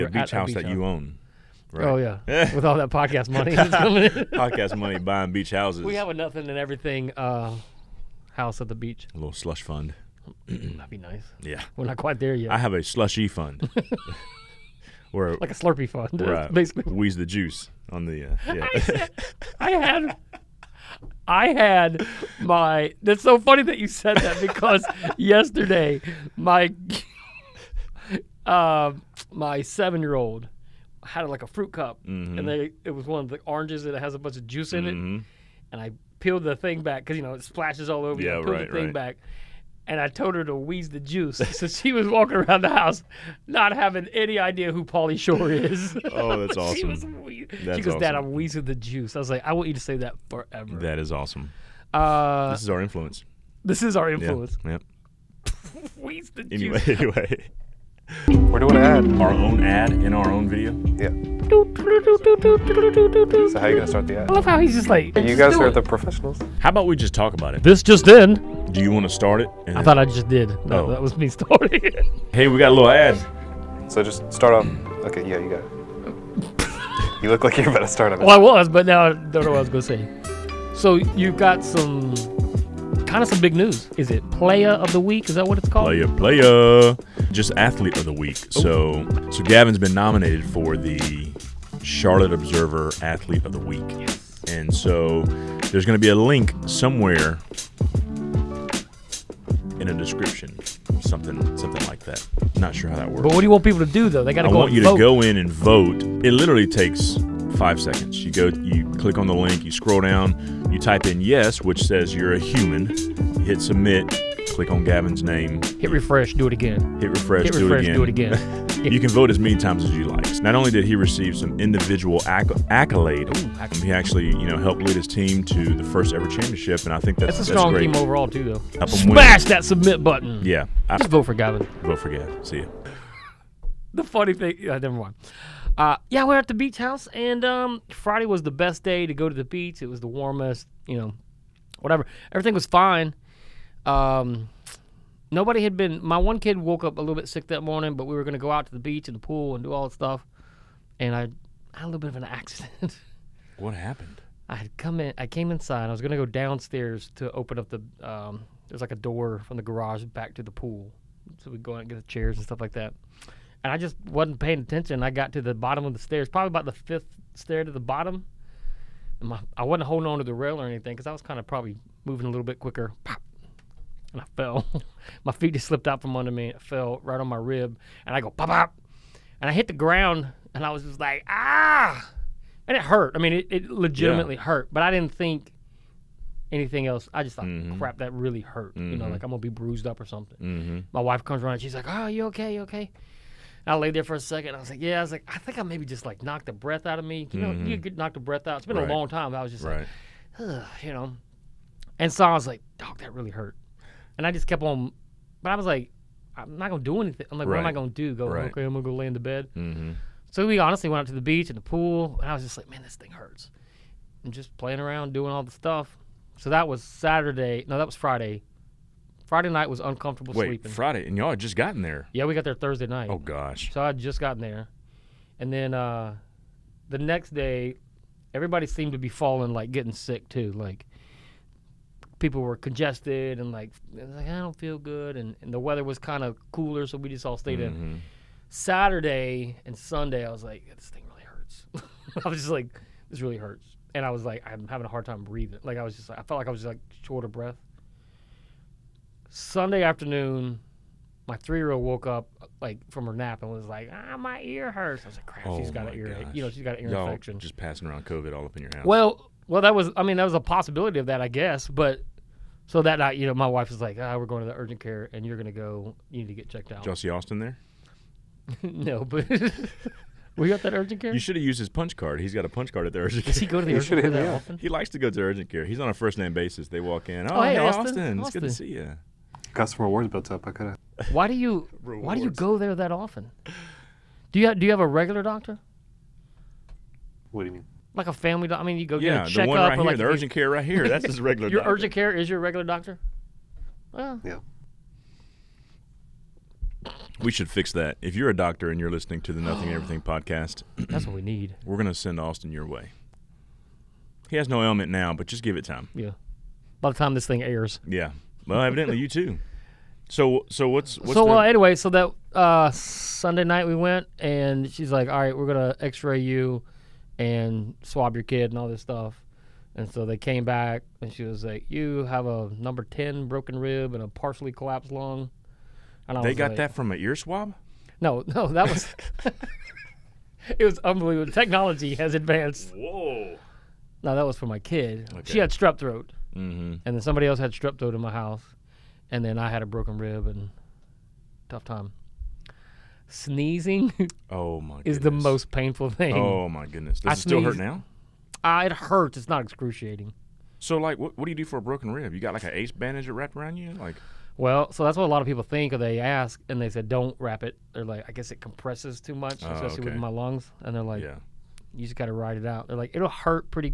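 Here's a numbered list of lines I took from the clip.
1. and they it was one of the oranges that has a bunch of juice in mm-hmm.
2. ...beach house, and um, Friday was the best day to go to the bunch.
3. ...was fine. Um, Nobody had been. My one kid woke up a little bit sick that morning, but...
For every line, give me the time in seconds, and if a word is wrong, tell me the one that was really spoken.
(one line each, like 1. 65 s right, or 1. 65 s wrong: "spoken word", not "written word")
1. 32 s right
2. 136 s wrong: "beach", not "bunch"
3. 142 s right.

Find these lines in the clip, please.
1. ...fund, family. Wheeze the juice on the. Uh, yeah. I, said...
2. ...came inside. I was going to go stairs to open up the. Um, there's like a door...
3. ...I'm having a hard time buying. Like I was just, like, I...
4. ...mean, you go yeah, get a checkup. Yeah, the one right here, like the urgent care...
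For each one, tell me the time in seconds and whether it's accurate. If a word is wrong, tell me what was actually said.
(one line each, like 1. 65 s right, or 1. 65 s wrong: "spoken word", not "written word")
1. 15 s wrong: "basically", not "family"
2. 155 s wrong: "downstairs", not "stairs"
3. 244 s wrong: "breathing", not "buying"
4. 288 s right.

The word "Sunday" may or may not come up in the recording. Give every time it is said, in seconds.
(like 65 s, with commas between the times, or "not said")
239 s, 249 s, 312 s.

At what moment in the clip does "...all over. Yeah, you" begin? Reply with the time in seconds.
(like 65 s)
37 s.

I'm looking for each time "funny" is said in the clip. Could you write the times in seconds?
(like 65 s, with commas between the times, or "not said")
23 s, 134 s.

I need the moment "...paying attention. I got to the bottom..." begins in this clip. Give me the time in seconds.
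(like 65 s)
164 s.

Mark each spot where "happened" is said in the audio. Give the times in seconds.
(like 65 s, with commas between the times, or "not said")
153 s.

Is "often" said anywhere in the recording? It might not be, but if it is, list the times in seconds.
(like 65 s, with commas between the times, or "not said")
274 s, 282 s.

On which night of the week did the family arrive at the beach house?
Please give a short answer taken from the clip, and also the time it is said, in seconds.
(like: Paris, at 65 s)
Thursday, at 222 s.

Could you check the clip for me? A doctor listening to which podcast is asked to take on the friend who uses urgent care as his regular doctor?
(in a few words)
Nothing Everything.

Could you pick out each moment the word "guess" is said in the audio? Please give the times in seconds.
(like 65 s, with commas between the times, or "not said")
261 s, 358 s.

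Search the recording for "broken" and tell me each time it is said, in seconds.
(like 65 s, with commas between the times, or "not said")
323 s, 339 s, 351 s.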